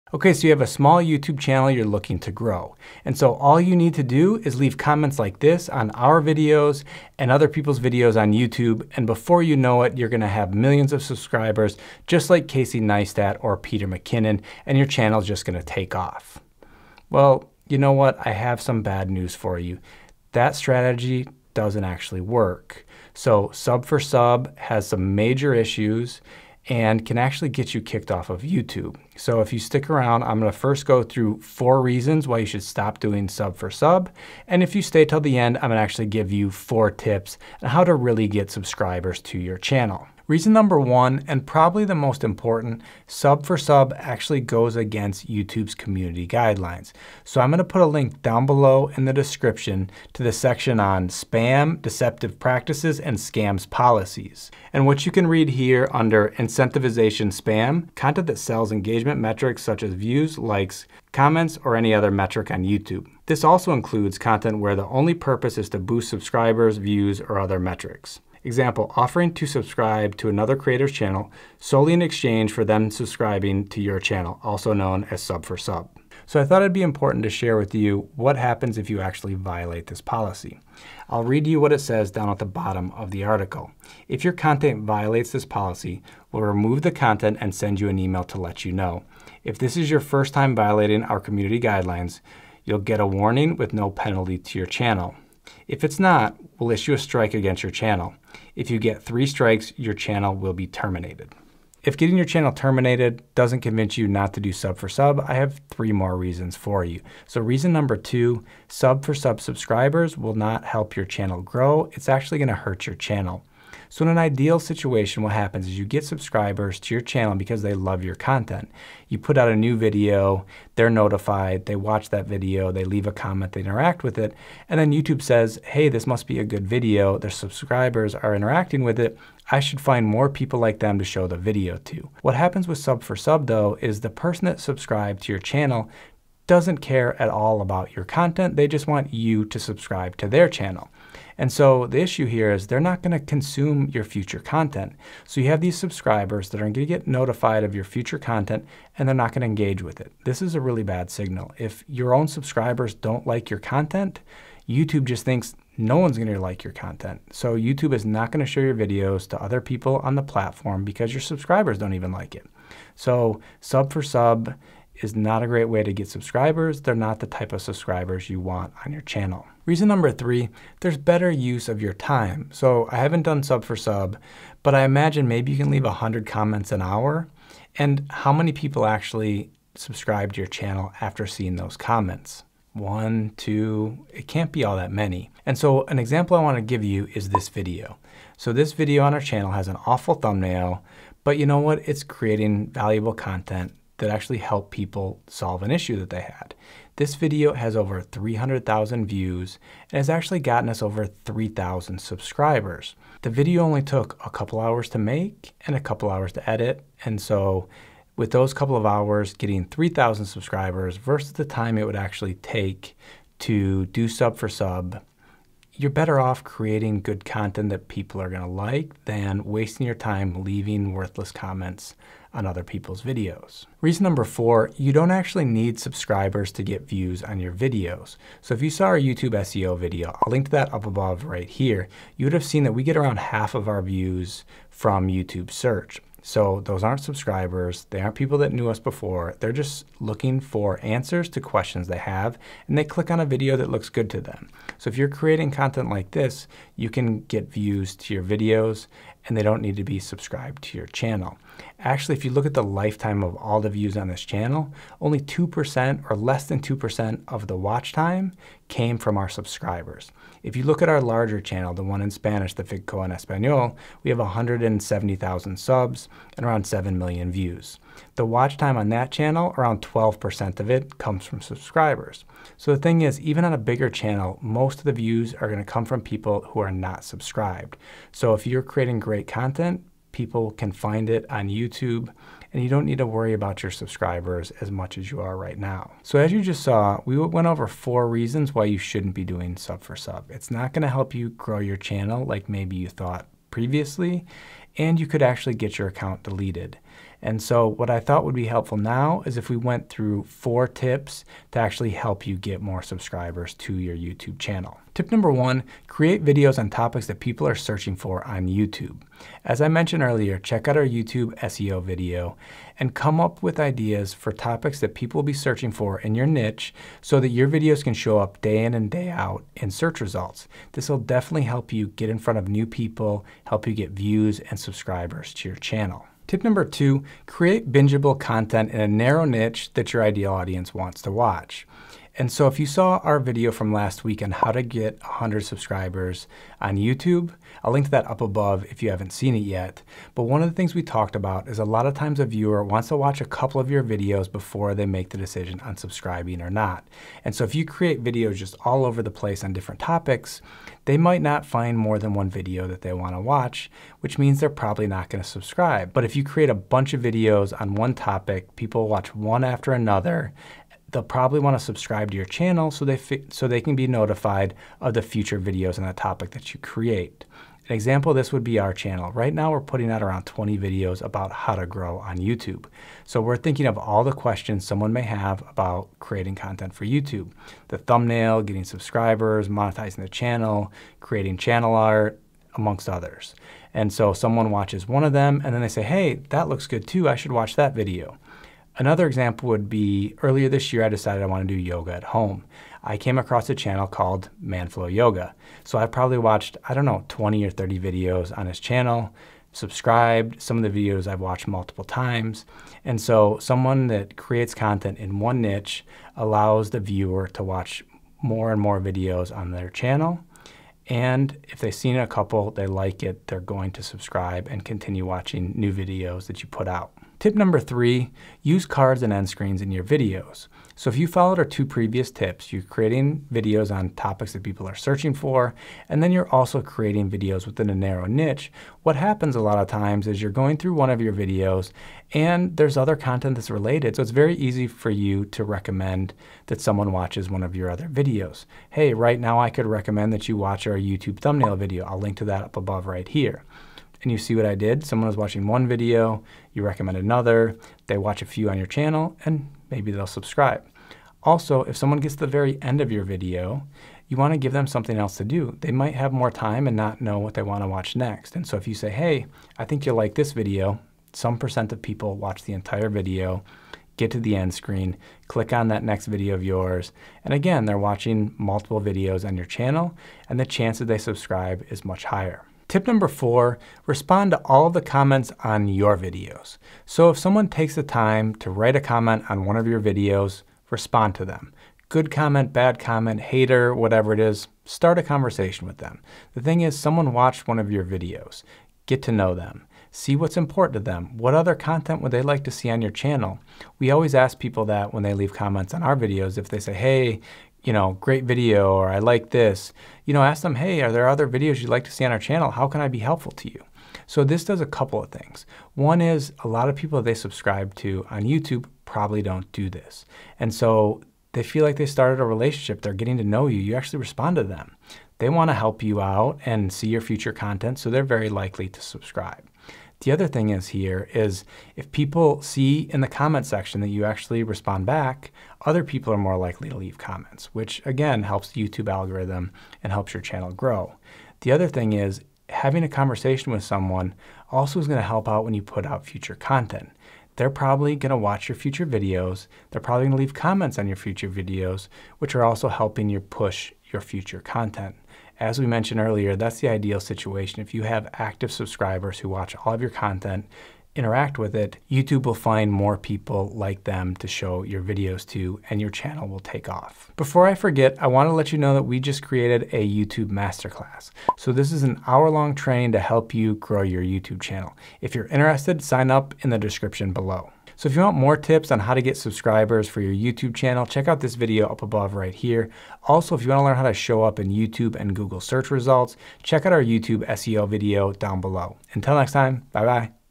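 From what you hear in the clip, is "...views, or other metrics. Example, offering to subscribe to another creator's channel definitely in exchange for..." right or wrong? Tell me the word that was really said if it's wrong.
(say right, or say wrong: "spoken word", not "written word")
wrong: "solely", not "definitely".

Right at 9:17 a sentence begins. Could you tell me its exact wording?
Before I forget, I wanna let you know that we just created a YouTube masterclass.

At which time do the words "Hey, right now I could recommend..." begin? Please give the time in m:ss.
7:18.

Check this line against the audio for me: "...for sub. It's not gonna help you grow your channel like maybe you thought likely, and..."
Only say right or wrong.
wrong.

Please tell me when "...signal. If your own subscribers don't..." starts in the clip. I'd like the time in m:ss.
2:31.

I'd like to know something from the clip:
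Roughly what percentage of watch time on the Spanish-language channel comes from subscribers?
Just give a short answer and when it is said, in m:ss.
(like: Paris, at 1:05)
12%, at 4:29.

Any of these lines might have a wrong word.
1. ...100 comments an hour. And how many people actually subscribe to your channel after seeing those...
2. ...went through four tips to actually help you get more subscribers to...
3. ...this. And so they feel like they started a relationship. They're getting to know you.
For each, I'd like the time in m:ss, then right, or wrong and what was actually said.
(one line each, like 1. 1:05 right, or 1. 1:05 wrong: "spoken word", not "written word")
1. 2:55 right
2. 4:59 right
3. 8:29 right.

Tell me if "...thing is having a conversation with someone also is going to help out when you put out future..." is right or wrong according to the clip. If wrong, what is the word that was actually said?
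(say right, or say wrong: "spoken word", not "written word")
right.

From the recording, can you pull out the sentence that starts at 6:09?
Right now we're putting out around 20 videos about how to grow on YouTube.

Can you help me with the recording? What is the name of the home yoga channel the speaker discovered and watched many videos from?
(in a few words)
Manflow Yoga.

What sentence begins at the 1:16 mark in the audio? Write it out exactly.
So I thought it'd be important to share with you what happens if you actually violate this policy.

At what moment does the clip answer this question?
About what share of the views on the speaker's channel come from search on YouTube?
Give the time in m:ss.
3:53.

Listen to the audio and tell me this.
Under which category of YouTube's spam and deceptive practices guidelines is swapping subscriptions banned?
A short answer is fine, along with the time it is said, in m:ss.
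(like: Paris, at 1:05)
incentivization spam, at 0:56.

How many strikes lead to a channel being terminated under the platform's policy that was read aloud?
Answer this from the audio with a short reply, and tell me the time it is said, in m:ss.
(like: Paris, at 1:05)
3, at 1:39.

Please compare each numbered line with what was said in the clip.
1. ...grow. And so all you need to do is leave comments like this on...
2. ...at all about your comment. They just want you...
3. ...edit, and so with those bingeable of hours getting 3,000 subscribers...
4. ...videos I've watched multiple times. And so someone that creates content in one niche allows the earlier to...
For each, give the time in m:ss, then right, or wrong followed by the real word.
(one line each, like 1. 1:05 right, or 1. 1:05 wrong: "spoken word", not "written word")
1. 0:02 right
2. 2:17 wrong: "content", not "comment"
3. 3:26 wrong: "couple", not "bingeable"
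4. 6:40 wrong: "viewer", not "earlier".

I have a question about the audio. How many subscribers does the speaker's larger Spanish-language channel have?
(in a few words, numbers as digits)
170,000.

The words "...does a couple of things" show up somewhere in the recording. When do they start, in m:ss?
8:24.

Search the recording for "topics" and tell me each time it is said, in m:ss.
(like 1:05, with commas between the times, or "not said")
5:06, 5:14, 5:49, 5:57, 6:05, 7:03.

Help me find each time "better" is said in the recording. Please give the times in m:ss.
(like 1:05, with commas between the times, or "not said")
2:50, 3:35.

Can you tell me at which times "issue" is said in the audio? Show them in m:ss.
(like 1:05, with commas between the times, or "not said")
0:25, 1:36, 2:21, 3:15.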